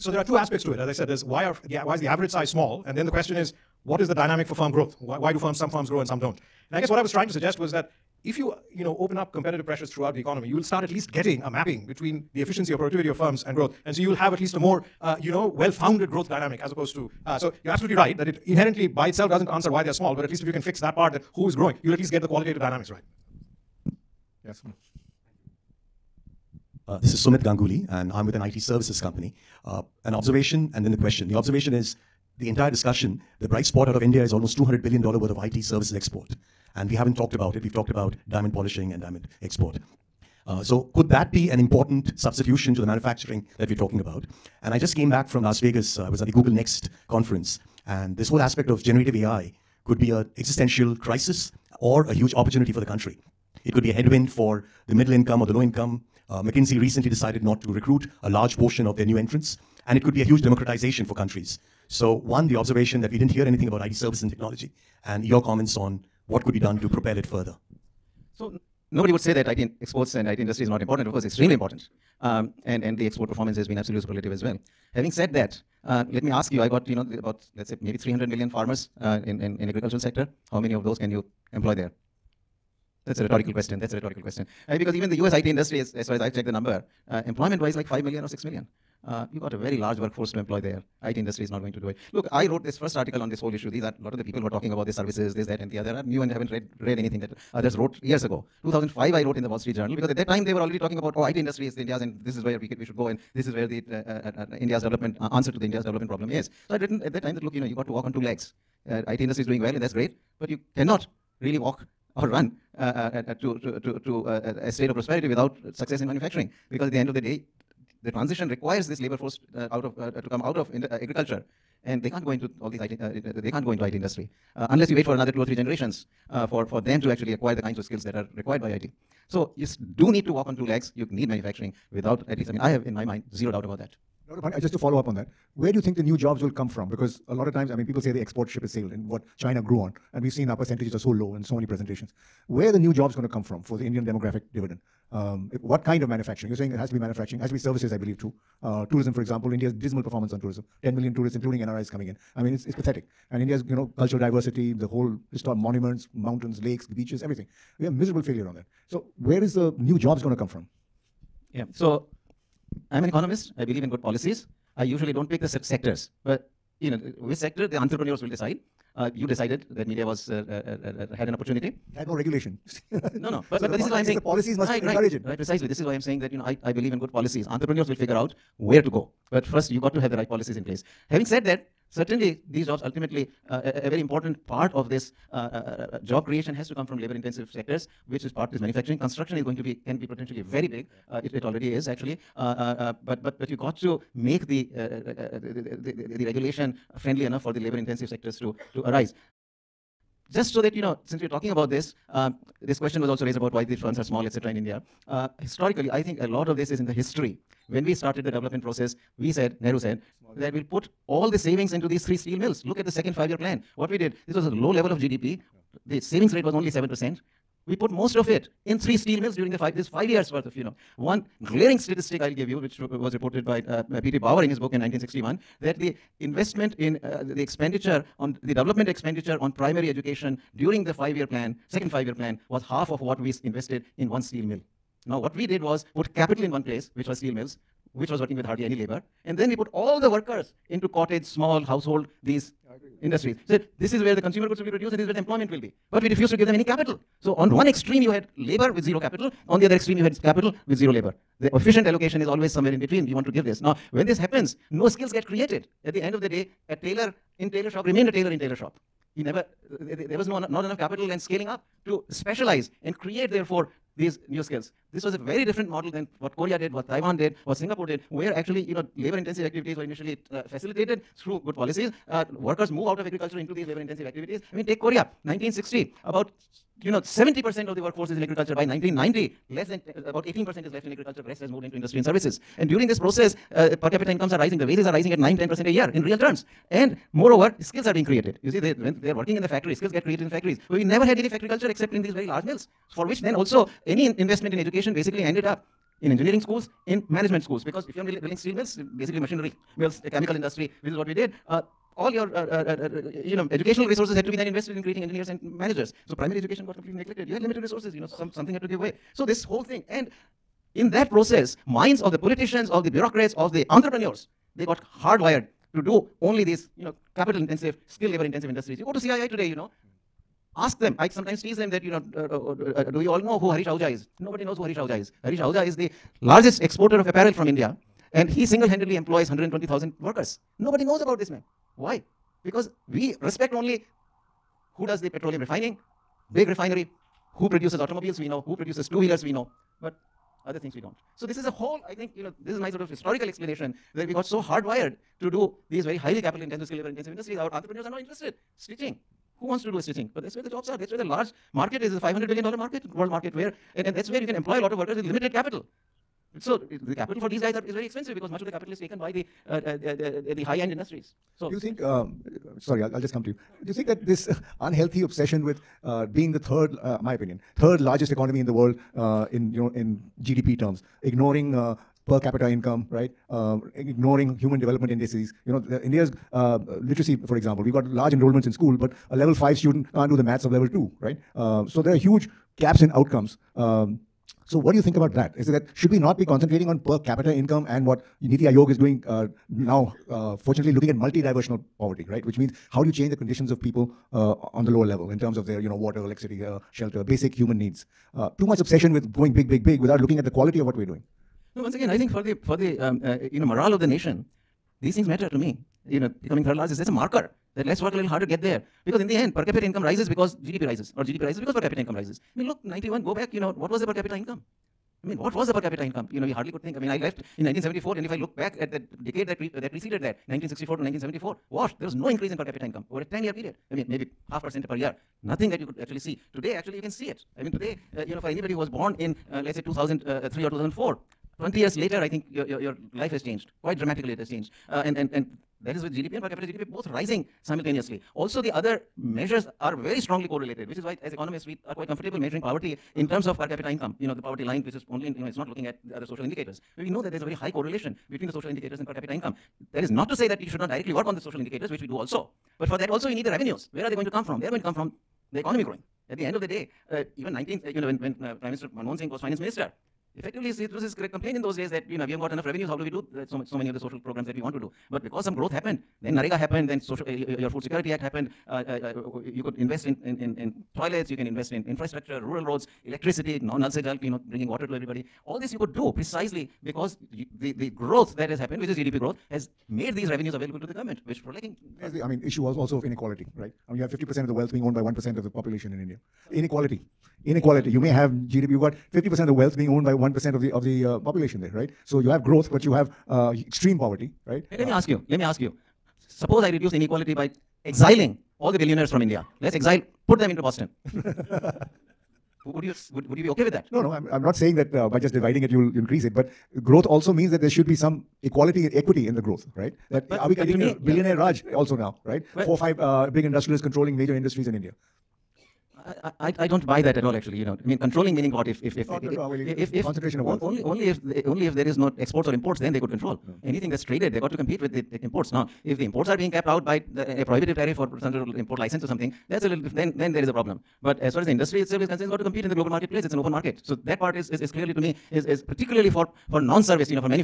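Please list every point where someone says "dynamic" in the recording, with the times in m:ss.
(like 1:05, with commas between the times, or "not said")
0:04, 0:16, 0:22.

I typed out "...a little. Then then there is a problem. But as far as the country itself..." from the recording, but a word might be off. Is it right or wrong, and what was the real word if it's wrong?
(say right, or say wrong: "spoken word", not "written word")
wrong: "industry", not "country".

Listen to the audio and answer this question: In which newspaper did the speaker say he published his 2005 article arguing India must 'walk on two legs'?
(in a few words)
Wall Street Journal.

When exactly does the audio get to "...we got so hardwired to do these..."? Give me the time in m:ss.
5:44.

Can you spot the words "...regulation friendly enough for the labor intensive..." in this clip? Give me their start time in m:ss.
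3:16.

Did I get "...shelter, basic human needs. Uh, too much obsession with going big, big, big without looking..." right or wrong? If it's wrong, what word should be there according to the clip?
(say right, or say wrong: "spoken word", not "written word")
right.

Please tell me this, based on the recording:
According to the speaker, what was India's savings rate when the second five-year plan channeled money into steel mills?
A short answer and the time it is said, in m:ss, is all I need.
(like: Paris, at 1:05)
7%, at 3:36.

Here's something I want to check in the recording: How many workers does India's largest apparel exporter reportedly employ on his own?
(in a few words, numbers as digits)
120,000.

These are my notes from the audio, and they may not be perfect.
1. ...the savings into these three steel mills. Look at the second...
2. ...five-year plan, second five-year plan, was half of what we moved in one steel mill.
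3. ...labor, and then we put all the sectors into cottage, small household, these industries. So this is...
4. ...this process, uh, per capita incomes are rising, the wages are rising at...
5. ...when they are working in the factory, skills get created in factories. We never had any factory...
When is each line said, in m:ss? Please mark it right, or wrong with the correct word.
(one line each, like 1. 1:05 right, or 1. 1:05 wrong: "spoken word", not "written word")
1. 3:31 right
2. 3:50 wrong: "invested", not "moved"
3. 3:58 wrong: "workers", not "sectors"
4. 4:42 right
5. 4:48 right.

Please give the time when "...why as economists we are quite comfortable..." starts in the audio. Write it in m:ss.
7:20.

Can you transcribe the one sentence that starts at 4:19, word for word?
He never there was no, not enough capital and scaling up to specialize and create, therefore, these new skills.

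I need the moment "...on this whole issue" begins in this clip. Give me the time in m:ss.
1:33.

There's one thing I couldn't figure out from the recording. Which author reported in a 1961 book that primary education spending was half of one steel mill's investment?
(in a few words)
P.T. Bauer.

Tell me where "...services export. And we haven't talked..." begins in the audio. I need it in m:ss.
0:35.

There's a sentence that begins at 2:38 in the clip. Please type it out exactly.
So where is the new jobs going to come from?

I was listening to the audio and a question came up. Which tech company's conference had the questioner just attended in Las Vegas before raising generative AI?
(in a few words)
Google Next.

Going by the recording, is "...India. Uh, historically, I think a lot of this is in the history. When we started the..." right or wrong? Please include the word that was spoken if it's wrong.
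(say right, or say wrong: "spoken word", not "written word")
right.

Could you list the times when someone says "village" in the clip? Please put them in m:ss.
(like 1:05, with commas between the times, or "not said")
not said.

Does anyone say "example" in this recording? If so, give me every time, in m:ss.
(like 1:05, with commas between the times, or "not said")
2:29, 6:17.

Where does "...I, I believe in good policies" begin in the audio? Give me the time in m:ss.
2:56.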